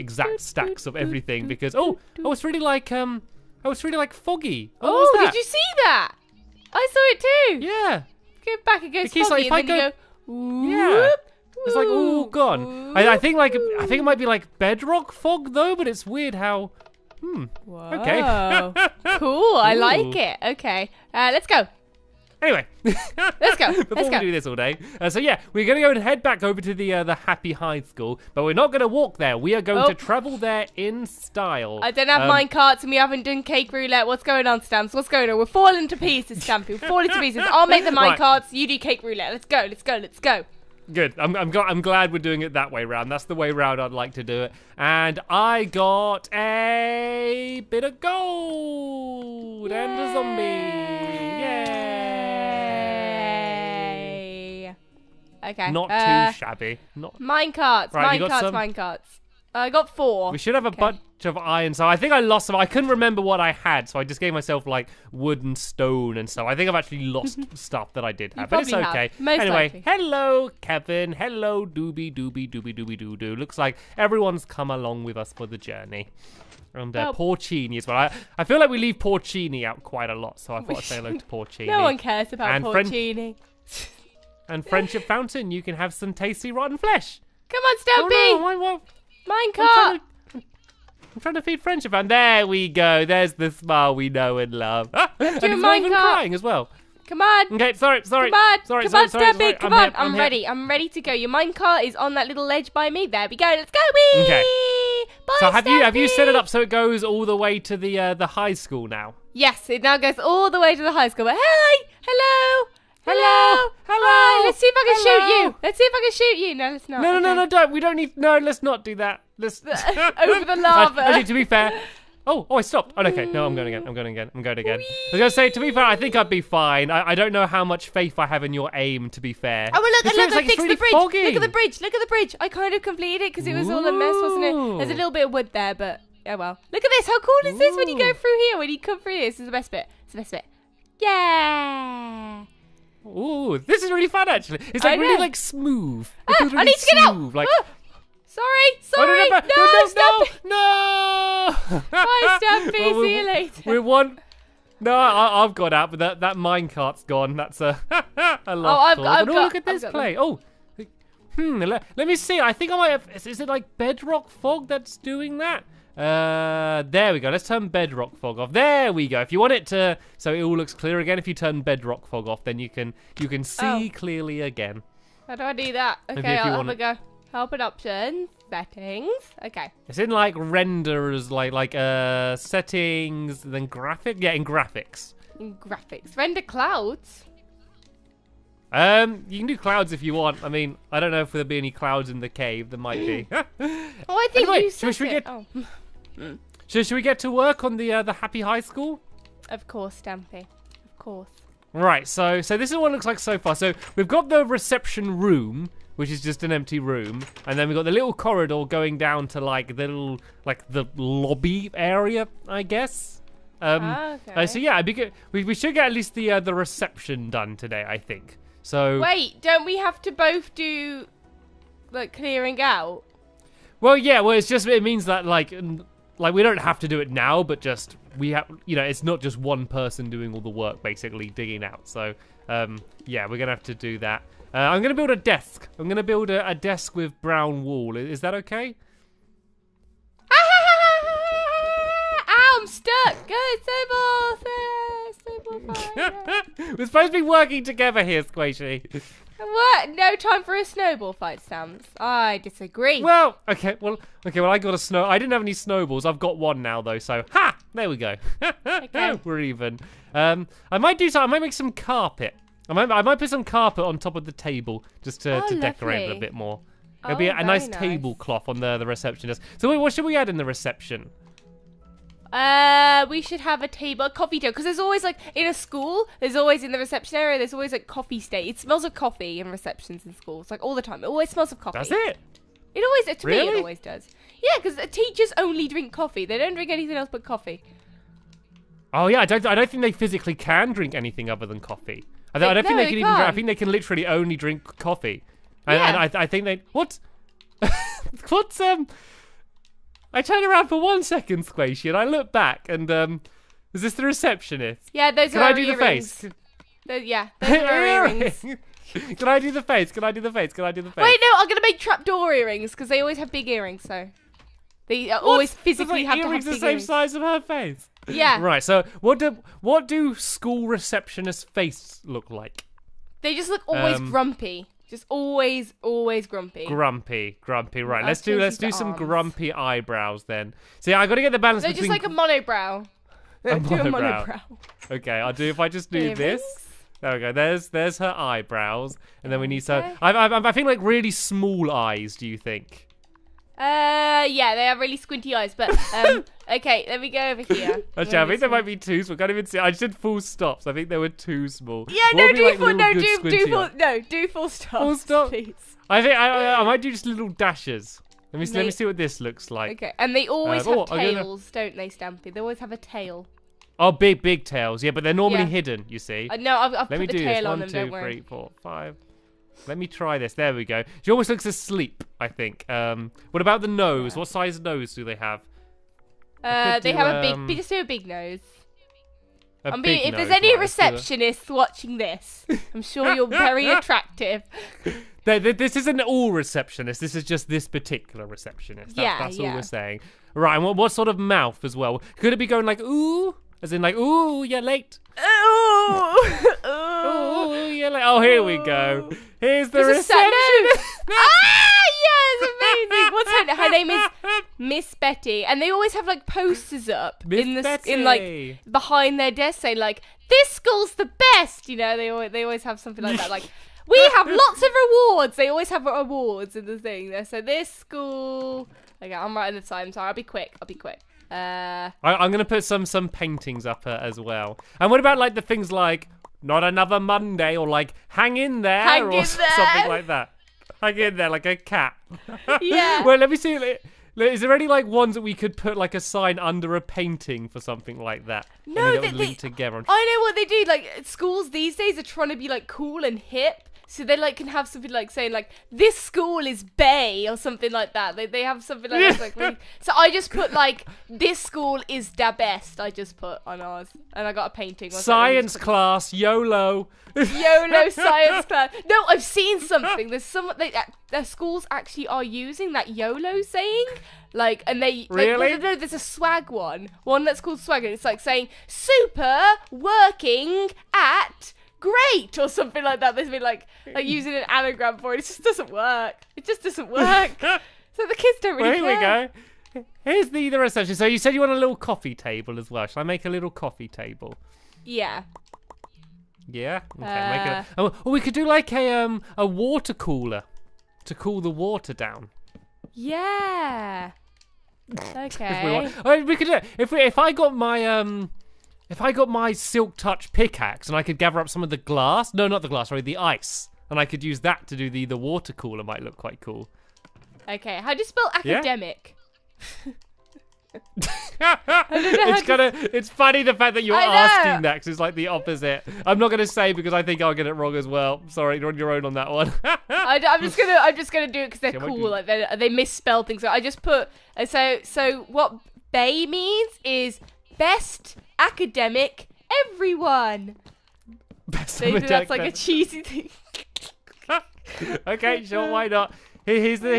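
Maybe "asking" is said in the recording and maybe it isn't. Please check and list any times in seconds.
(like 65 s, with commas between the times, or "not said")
513 s.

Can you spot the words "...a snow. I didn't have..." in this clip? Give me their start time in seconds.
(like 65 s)
254 s.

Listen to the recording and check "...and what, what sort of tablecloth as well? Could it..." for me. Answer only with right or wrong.
wrong.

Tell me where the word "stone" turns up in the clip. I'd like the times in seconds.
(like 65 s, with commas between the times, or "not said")
65 s.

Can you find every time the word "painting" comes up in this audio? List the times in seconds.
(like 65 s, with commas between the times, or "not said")
423 s, 436 s, 454 s.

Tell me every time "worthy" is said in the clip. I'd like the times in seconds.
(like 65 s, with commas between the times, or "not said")
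not said.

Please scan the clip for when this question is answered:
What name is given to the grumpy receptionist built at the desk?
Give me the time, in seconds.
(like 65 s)
404 s.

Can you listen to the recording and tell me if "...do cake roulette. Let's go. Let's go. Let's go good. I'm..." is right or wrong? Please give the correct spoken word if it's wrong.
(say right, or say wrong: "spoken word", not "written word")
right.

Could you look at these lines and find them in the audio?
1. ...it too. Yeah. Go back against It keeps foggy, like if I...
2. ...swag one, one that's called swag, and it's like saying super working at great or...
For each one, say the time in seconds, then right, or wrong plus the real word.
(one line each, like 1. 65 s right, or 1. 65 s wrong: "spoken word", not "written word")
1. 7 s right
2. 465 s right.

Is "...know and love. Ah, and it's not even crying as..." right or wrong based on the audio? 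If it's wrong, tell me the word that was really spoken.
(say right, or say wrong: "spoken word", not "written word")
right.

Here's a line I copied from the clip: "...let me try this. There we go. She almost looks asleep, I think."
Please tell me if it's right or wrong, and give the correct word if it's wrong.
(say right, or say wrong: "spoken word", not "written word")
right.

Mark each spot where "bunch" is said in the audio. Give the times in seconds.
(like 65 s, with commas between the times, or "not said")
60 s.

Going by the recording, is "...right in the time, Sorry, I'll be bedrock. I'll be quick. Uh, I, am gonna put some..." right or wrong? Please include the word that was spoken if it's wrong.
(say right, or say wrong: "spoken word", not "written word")
wrong: "quick", not "bedrock".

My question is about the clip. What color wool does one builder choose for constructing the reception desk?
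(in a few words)
Brown.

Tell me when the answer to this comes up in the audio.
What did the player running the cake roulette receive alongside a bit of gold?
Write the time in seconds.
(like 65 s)
50 s.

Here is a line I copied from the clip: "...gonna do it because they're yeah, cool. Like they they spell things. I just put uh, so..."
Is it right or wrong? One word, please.
wrong.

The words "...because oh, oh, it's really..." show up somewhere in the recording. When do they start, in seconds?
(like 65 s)
1 s.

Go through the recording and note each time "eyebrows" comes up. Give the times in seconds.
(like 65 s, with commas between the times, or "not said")
329 s, 338 s.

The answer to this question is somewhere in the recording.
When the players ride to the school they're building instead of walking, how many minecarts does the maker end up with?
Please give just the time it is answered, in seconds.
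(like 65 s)
59 s.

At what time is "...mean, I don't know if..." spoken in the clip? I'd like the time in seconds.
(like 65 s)
190 s.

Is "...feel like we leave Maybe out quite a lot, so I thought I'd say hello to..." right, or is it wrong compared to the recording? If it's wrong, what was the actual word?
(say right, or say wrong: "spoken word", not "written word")
wrong: "Porcini", not "Maybe".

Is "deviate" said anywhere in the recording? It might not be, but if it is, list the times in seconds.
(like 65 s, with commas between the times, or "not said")
not said.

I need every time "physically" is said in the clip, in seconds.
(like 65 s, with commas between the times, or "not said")
289 s, 315 s.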